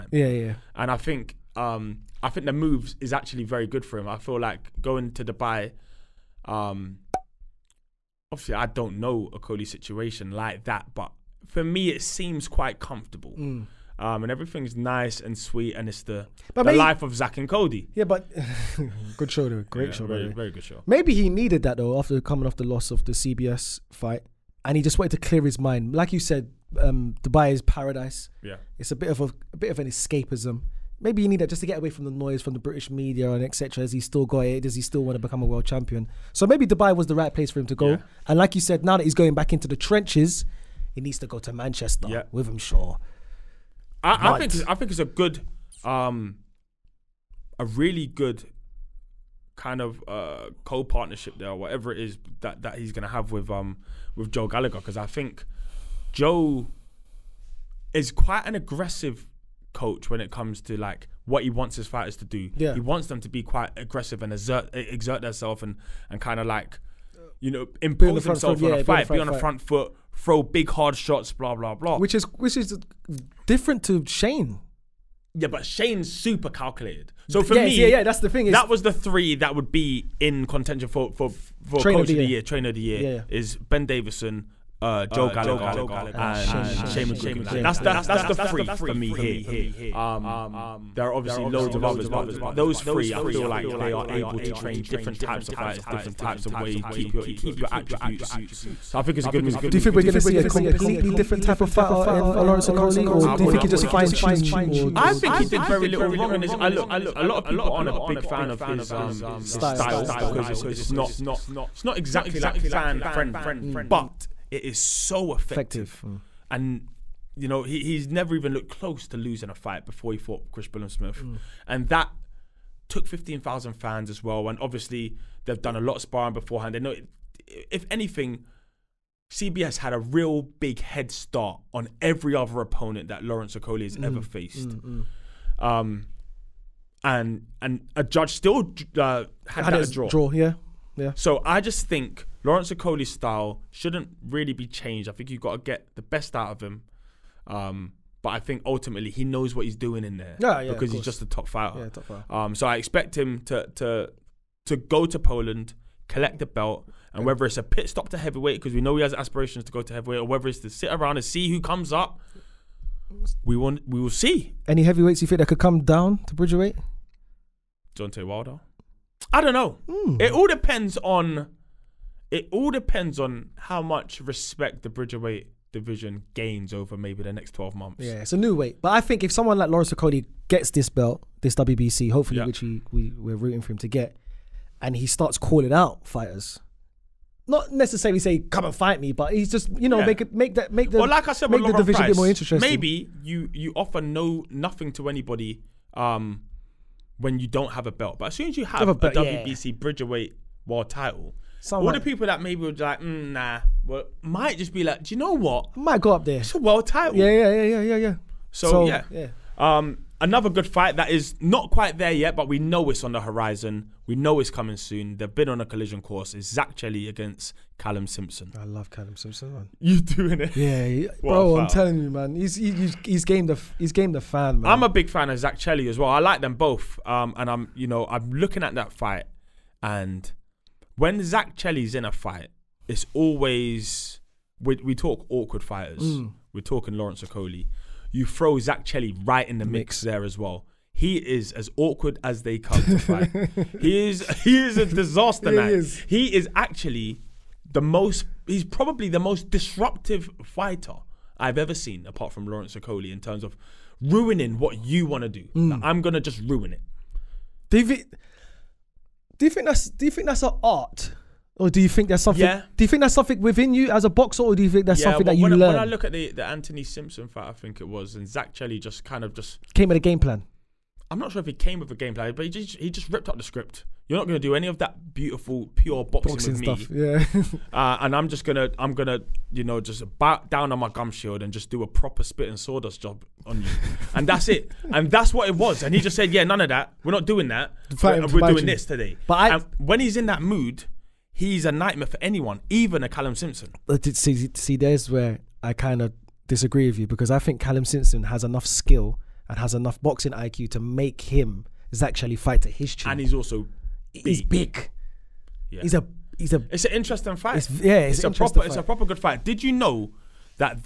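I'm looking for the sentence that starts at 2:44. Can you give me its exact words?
Any heavyweights you think that could come down to bridgeweight?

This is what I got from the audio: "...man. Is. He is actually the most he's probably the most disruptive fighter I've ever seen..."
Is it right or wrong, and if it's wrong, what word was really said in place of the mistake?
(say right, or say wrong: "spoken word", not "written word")
right.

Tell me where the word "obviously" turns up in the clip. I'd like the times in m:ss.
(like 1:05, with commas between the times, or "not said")
0:08, 1:31, 2:04.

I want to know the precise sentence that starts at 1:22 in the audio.
year, trainer of the year yeah, yeah.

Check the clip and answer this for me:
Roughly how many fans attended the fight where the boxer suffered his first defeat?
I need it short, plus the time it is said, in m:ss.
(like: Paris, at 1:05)
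15,000, at 2:03.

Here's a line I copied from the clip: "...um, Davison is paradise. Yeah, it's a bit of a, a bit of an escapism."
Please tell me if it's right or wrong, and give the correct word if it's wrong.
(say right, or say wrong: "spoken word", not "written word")
wrong: "Dubai", not "Davison".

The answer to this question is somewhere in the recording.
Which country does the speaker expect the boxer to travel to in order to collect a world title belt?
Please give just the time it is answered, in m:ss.
2:35.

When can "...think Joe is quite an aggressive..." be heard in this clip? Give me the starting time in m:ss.
0:55.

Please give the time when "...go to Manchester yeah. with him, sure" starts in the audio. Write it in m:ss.
0:41.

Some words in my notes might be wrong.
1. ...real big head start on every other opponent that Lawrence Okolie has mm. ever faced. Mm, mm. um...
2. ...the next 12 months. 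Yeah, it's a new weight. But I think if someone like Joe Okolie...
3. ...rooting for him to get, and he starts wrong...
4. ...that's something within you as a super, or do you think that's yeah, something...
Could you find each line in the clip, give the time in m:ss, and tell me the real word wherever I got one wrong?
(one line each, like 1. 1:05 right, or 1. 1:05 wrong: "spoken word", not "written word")
1. 2:09 right
2. 2:57 wrong: "Lawrence", not "Joe"
3. 3:03 wrong: "calling", not "wrong"
4. 4:23 wrong: "boxer", not "super".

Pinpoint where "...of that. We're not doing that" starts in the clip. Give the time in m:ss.
4:46.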